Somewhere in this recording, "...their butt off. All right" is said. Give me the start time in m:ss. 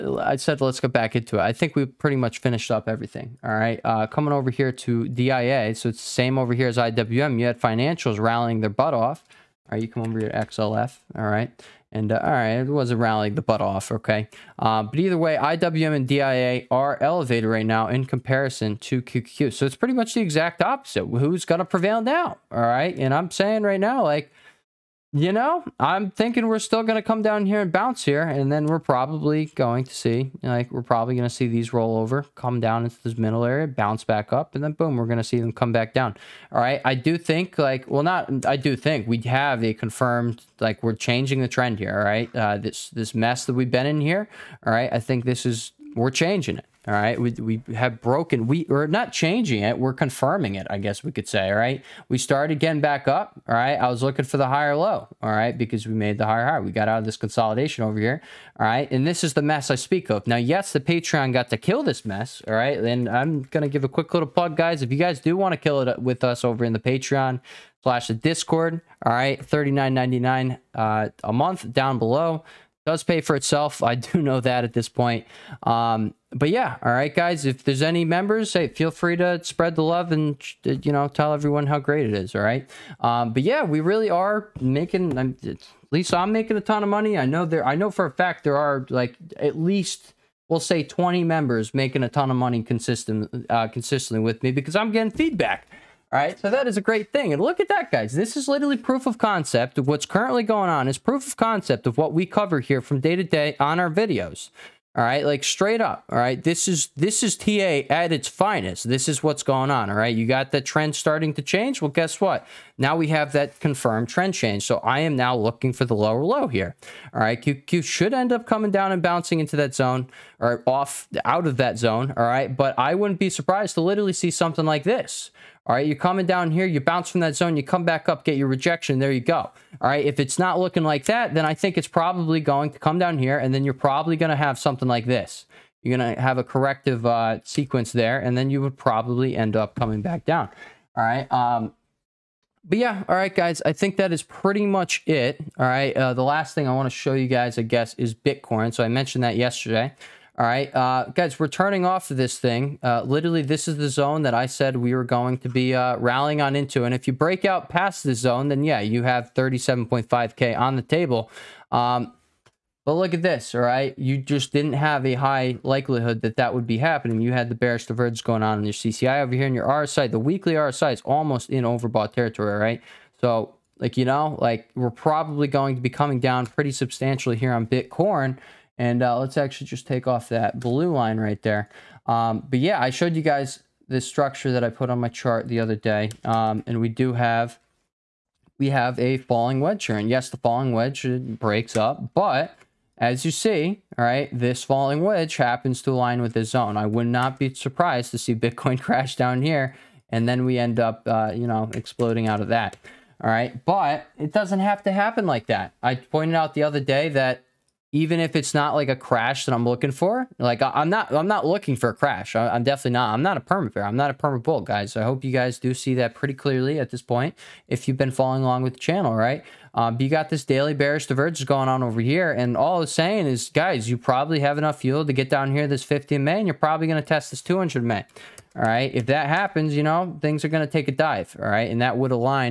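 0:08.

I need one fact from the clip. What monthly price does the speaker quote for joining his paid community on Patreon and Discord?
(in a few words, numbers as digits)
$39.99.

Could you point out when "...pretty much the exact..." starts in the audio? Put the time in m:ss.
0:19.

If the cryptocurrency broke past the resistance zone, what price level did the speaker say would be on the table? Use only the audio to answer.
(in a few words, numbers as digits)
37.5K.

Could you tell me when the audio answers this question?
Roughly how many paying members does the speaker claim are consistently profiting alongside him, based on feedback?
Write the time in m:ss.
1:30.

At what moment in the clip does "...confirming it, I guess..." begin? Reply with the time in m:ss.
0:49.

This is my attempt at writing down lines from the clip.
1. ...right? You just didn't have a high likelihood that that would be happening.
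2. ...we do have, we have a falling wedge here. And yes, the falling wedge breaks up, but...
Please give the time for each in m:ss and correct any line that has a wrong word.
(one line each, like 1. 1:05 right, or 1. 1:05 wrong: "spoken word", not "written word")
1. 2:43 right
2. 3:06 right.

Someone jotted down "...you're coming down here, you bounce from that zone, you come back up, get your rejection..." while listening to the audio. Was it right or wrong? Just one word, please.
right.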